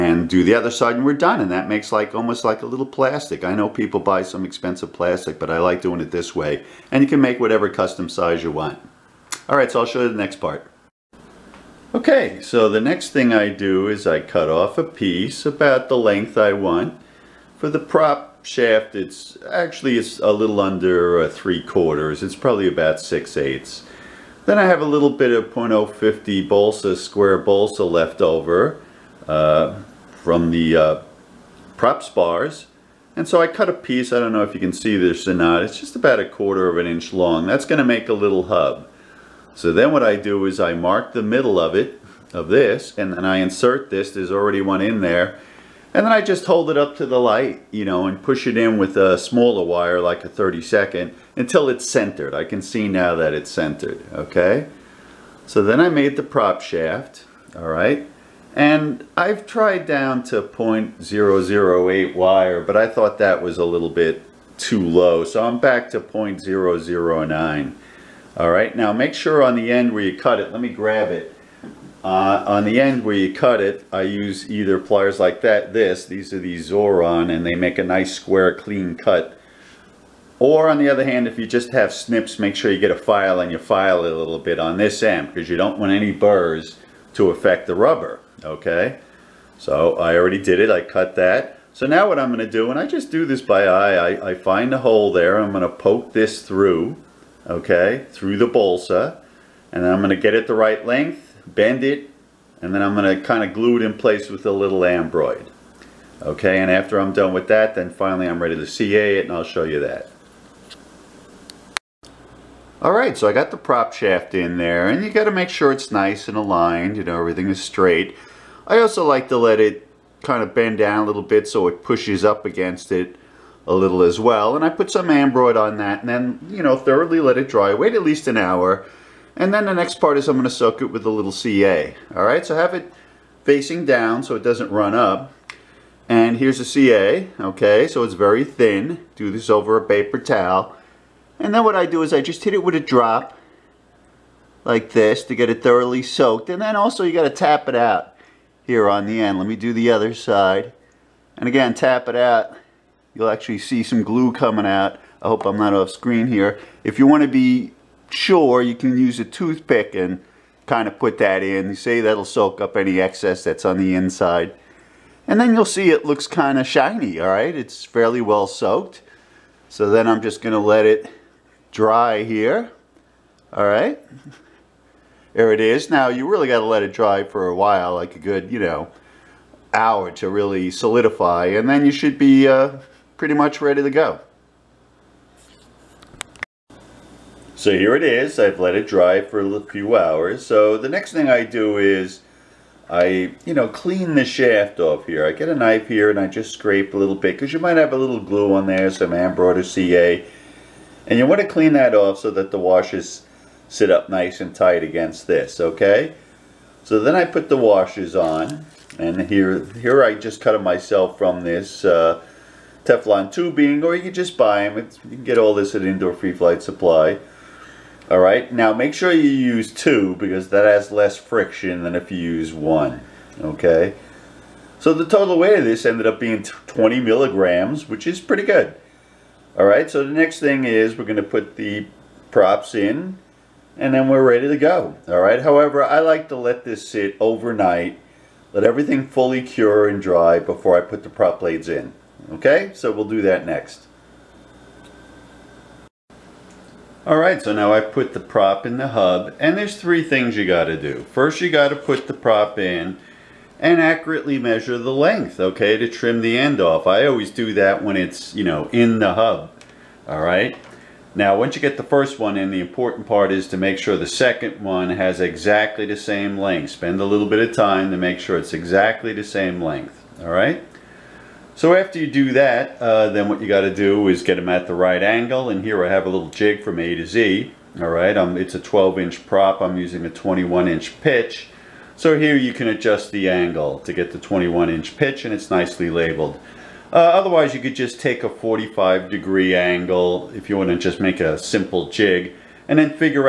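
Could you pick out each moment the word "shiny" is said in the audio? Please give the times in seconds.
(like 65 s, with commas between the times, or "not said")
166 s.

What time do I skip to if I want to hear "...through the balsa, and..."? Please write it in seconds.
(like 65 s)
98 s.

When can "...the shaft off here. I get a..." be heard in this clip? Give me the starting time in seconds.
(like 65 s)
194 s.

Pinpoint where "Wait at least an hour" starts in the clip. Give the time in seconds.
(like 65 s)
127 s.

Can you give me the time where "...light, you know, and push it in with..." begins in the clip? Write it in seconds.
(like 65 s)
47 s.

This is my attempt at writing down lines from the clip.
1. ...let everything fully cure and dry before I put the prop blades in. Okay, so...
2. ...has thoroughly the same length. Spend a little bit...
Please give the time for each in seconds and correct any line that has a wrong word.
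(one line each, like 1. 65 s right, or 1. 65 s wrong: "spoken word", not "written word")
1. 238 s right
2. 264 s wrong: "exactly", not "thoroughly".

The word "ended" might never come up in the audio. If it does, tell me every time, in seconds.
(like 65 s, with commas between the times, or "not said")
225 s.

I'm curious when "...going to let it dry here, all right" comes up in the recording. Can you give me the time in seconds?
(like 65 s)
170 s.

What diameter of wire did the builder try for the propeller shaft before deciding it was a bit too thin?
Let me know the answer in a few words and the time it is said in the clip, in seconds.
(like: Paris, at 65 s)
0.008, at 60 s.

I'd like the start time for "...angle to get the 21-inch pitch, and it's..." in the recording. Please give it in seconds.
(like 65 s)
283 s.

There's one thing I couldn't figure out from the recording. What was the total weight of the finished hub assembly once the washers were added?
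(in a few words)
20 milligrams.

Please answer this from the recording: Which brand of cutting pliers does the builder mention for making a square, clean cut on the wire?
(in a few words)
Xuron.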